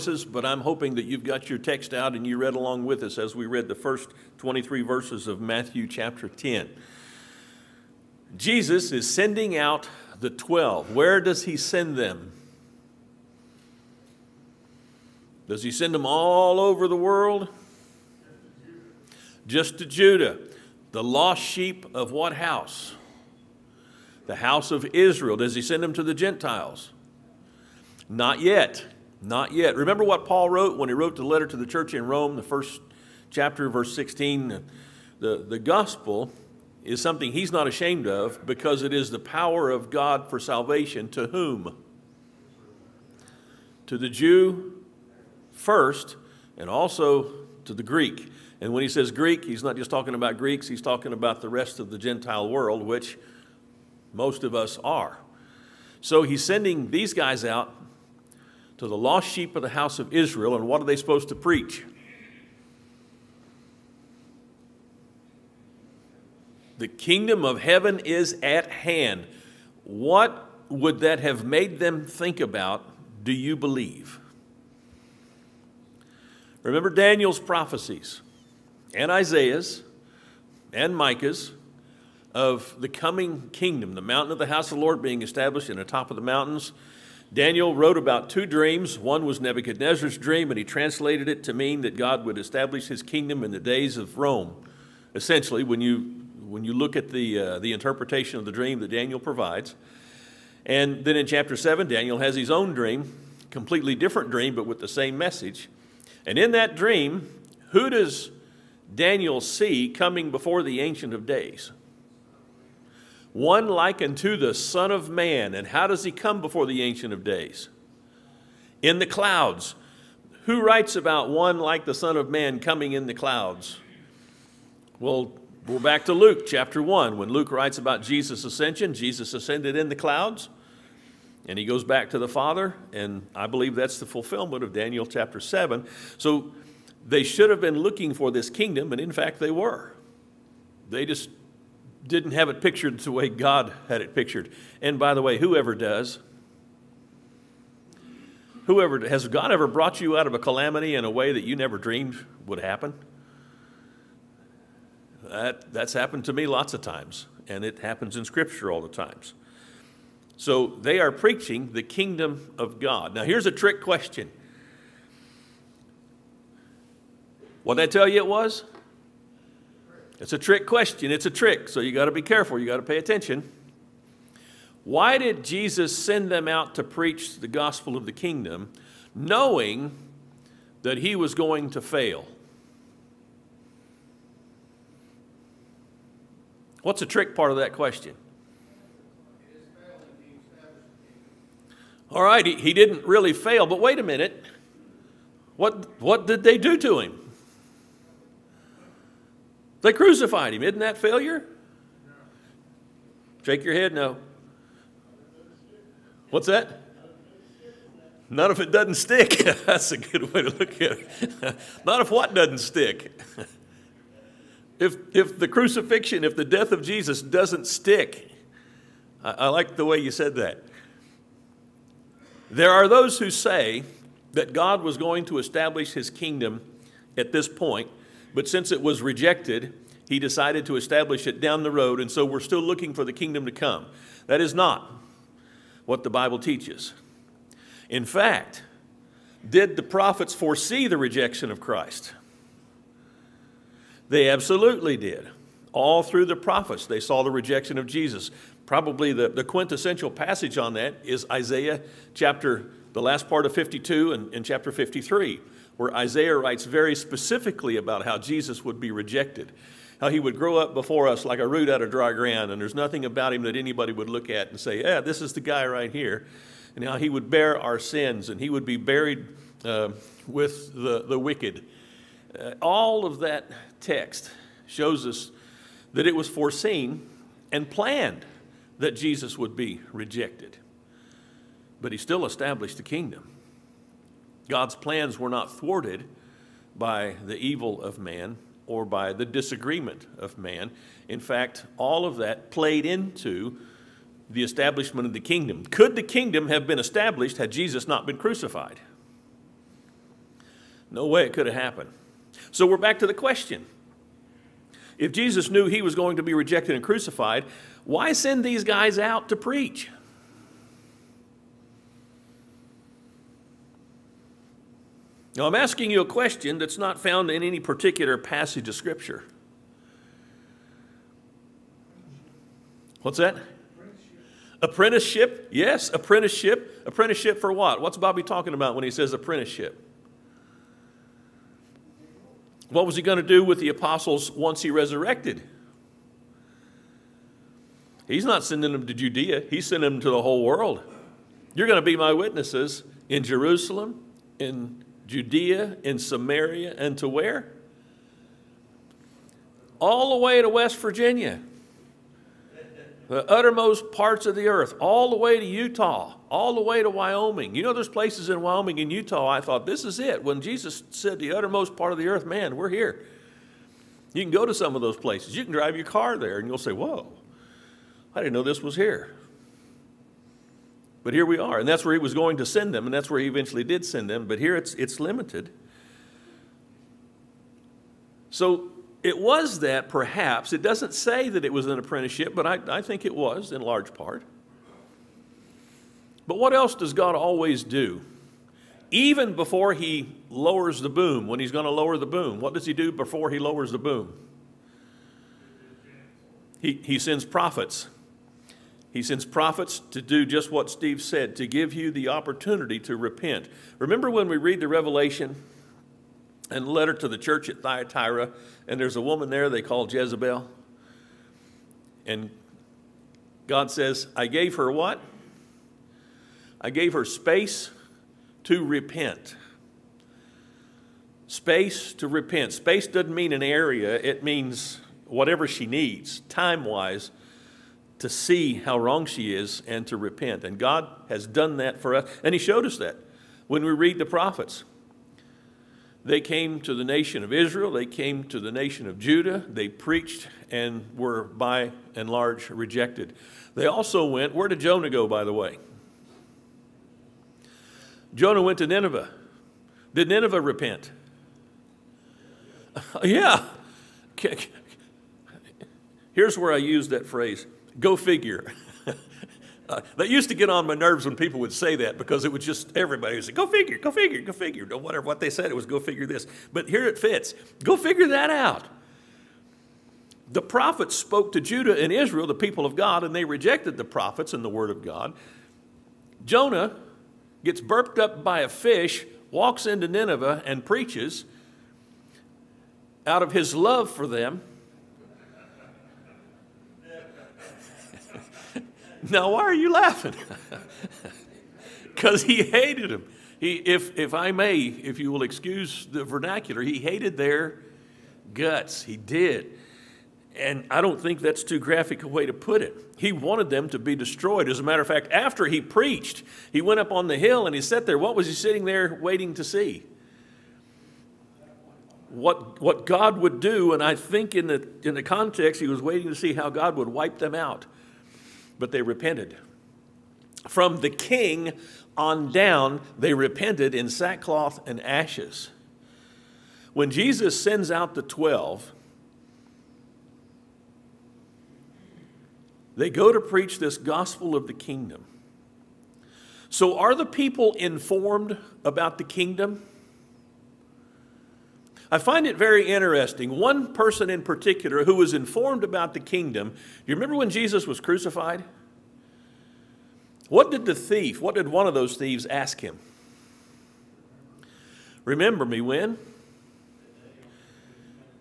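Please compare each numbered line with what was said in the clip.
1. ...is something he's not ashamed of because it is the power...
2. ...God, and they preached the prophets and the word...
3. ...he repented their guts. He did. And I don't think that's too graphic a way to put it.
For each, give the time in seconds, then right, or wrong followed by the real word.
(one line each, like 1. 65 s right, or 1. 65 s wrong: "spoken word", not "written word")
1. 36 s right
2. 472 s wrong: "rejected", not "preached"
3. 496 s wrong: "hated", not "repented".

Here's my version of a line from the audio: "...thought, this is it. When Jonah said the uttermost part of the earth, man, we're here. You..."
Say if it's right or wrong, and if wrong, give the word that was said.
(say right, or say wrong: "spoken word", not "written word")
wrong: "Jesus", not "Jonah".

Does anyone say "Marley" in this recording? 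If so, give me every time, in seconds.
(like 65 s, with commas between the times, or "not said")
not said.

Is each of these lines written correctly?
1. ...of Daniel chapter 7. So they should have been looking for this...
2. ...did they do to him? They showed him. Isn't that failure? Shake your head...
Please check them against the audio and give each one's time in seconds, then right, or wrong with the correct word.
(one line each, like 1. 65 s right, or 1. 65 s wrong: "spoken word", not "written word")
1. 134 s right
2. 196 s wrong: "crucified", not "showed".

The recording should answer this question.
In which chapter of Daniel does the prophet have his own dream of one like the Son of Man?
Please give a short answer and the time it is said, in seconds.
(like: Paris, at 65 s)
Chapter 7, at 101 s.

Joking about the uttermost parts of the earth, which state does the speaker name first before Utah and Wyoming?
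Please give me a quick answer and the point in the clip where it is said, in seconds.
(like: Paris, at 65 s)
West Virginia, at 350 s.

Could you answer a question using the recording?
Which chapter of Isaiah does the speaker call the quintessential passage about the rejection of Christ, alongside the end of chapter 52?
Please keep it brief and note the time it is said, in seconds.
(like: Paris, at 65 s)
Chapter 53, at 254 s.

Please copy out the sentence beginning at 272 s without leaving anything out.
Uh, all of that text shows us that it was foreseen and planned that Jesus would be rejected.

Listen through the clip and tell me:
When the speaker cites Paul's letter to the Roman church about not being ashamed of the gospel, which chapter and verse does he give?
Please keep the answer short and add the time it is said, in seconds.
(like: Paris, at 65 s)
Chapter 1, verse 16, at 32 s.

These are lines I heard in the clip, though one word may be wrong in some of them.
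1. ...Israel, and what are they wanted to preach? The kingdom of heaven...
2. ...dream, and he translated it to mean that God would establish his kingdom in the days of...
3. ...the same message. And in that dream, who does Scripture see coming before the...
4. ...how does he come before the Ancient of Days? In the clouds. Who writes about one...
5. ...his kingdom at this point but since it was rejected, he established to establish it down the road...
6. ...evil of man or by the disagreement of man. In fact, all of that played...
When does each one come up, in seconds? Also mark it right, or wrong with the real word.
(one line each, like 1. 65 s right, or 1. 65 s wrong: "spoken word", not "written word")
1. 60 s wrong: "supposed", not "wanted"
2. 90 s right
3. 104 s wrong: "Daniel", not "Scripture"
4. 115 s right
5. 225 s wrong: "decided", not "established"
6. 287 s right.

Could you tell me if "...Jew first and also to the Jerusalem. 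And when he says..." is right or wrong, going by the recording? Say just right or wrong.
wrong.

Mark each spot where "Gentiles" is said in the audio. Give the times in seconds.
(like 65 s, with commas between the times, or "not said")
26 s, 51 s.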